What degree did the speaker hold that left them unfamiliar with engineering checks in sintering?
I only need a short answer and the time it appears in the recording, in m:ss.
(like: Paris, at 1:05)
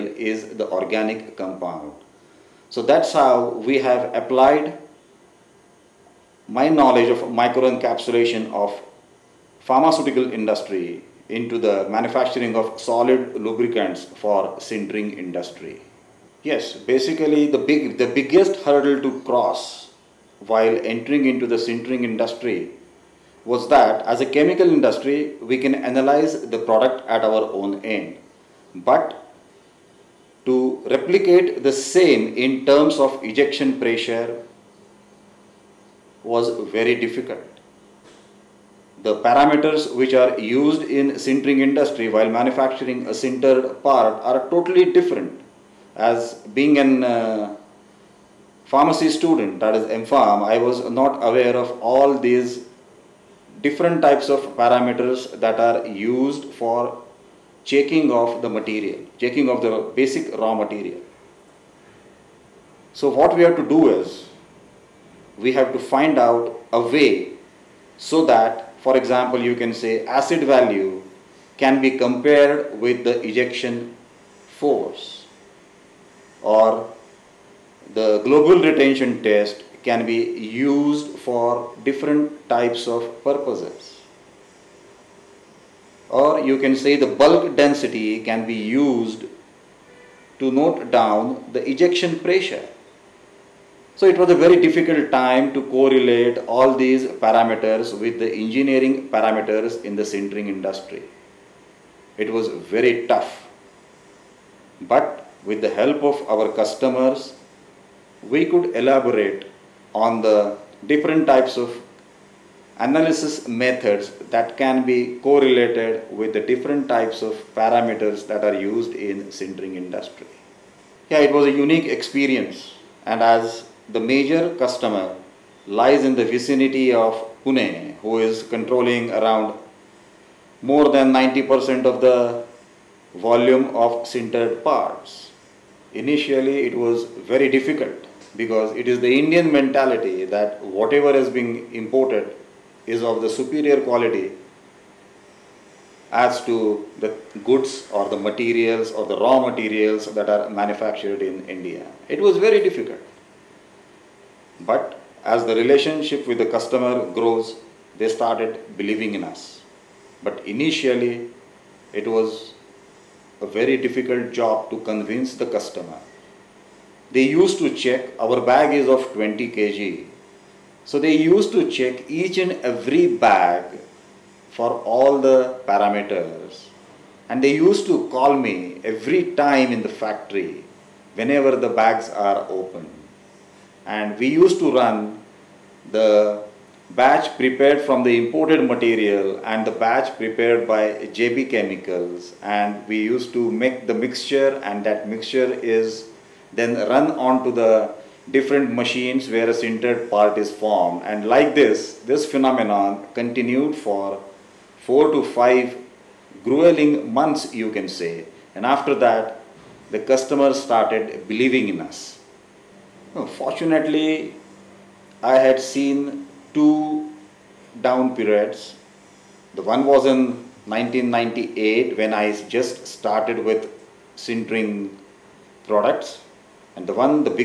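MPharm, at 0:50.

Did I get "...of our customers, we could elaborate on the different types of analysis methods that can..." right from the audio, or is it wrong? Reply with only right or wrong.
right.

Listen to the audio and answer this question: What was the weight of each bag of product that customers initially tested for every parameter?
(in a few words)
20 kg.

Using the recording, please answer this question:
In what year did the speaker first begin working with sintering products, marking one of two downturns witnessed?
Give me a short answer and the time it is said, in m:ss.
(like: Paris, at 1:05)
1998, at 3:40.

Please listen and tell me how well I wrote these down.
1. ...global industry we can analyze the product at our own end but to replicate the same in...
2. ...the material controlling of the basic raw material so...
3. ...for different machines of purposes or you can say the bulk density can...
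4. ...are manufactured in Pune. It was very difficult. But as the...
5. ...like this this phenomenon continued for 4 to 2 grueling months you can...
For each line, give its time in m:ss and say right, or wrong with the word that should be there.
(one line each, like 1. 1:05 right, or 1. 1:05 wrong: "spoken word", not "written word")
1. 0:24 wrong: "chemical", not "global"
2. 0:58 wrong: "checking", not "controlling"
3. 1:21 wrong: "types", not "machines"
4. 2:30 wrong: "India", not "Pune"
5. 3:21 wrong: "5", not "2".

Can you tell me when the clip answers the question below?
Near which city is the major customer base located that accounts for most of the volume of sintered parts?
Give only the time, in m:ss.
2:07.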